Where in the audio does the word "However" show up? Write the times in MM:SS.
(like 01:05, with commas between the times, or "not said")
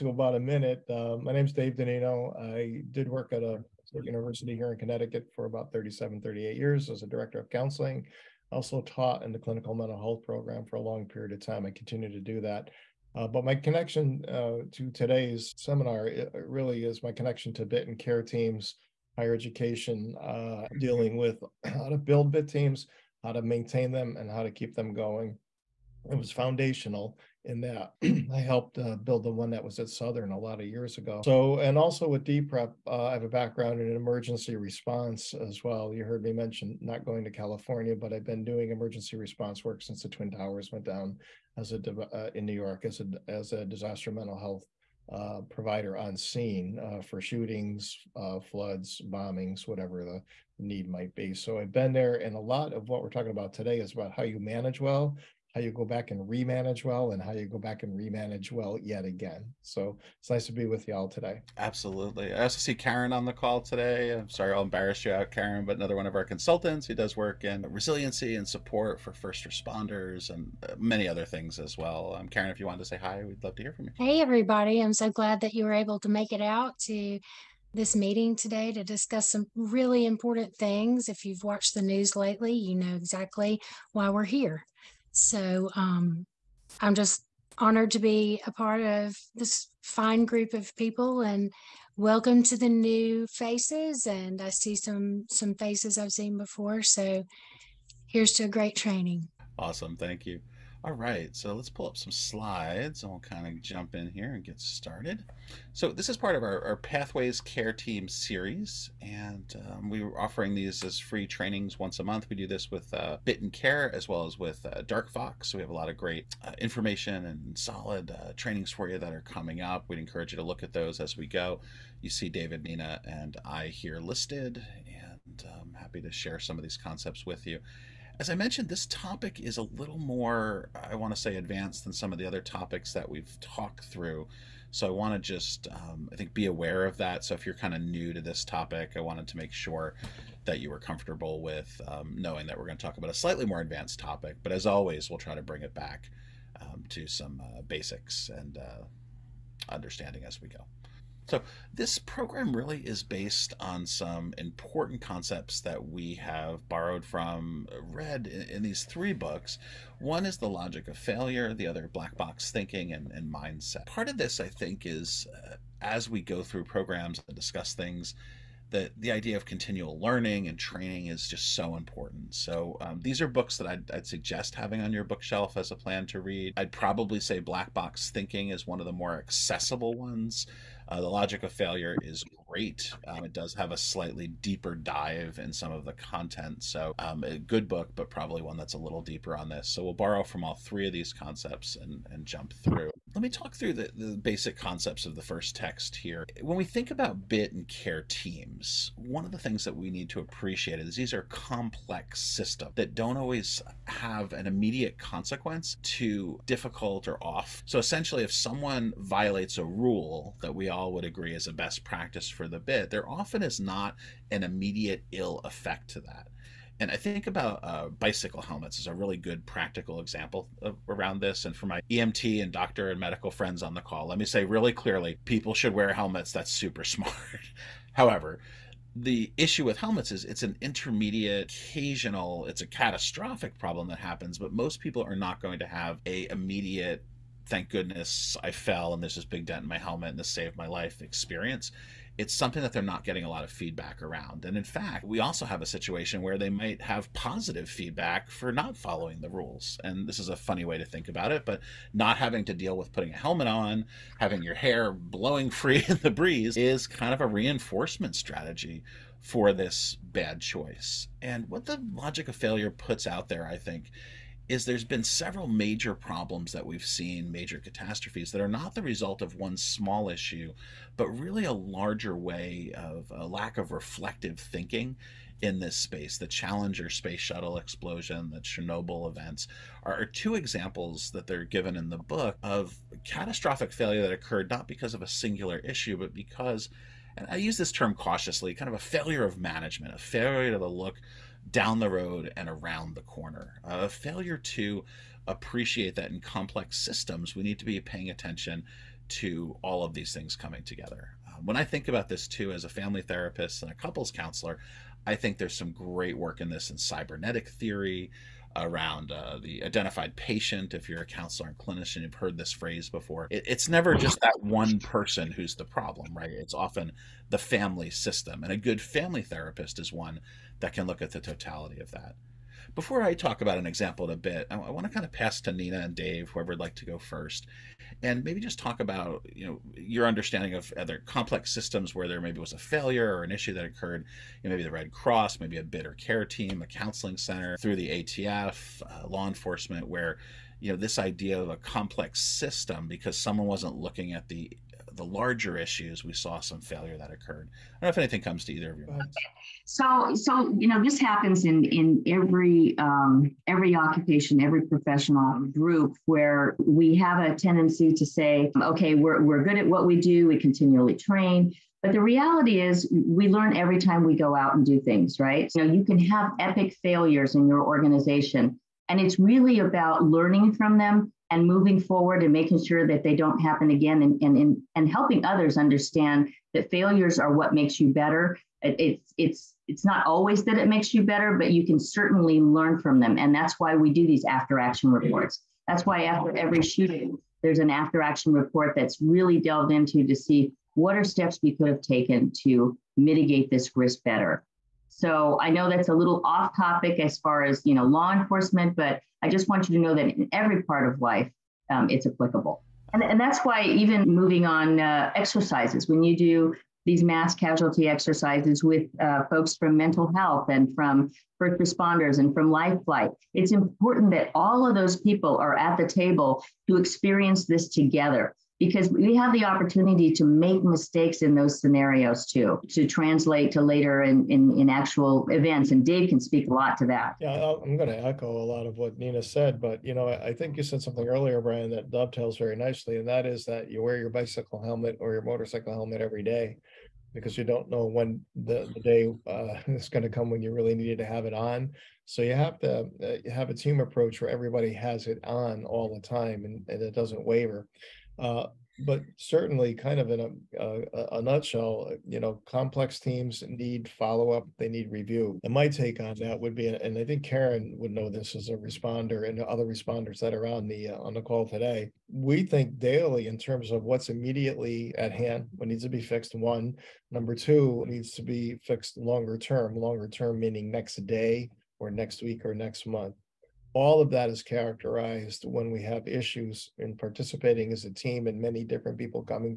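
03:47.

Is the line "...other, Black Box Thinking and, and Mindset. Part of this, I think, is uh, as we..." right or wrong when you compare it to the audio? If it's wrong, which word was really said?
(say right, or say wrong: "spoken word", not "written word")
right.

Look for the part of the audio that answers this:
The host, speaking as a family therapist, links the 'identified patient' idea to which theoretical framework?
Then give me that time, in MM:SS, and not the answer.
05:06.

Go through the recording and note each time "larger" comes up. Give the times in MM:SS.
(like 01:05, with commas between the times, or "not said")
04:31, 05:45.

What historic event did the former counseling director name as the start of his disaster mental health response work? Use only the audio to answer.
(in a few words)
Twin Towers.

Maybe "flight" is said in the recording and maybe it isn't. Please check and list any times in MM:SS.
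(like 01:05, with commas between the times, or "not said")
06:52.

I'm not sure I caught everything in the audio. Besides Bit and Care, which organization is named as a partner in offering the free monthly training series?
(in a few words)
Dark Fox.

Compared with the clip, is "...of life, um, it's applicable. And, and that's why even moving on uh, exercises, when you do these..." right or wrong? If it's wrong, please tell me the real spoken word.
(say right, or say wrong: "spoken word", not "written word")
right.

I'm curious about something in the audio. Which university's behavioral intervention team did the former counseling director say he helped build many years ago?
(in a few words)
Southern.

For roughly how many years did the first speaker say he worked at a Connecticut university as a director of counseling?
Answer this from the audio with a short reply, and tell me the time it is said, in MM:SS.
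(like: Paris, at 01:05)
37, 38, at 00:05.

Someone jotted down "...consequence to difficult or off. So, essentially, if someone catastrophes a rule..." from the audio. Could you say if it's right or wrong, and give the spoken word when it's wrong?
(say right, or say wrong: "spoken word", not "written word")
wrong: "violates", not "catastrophes".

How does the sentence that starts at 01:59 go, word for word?
We'd encourage you to look at those as we go.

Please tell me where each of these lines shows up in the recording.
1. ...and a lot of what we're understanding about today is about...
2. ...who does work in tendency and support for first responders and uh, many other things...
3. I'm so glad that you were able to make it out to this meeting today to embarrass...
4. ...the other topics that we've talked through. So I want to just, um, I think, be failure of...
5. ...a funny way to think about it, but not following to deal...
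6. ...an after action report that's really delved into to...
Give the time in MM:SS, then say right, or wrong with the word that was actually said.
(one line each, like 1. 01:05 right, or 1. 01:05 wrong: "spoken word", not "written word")
1. 00:52 wrong: "talking", not "understanding"
2. 01:06 wrong: "resiliency", not "tendency"
3. 01:14 wrong: "discuss", not "embarrass"
4. 02:12 wrong: "aware", not "failure"
5. 04:10 wrong: "having", not "following"
6. 06:27 right.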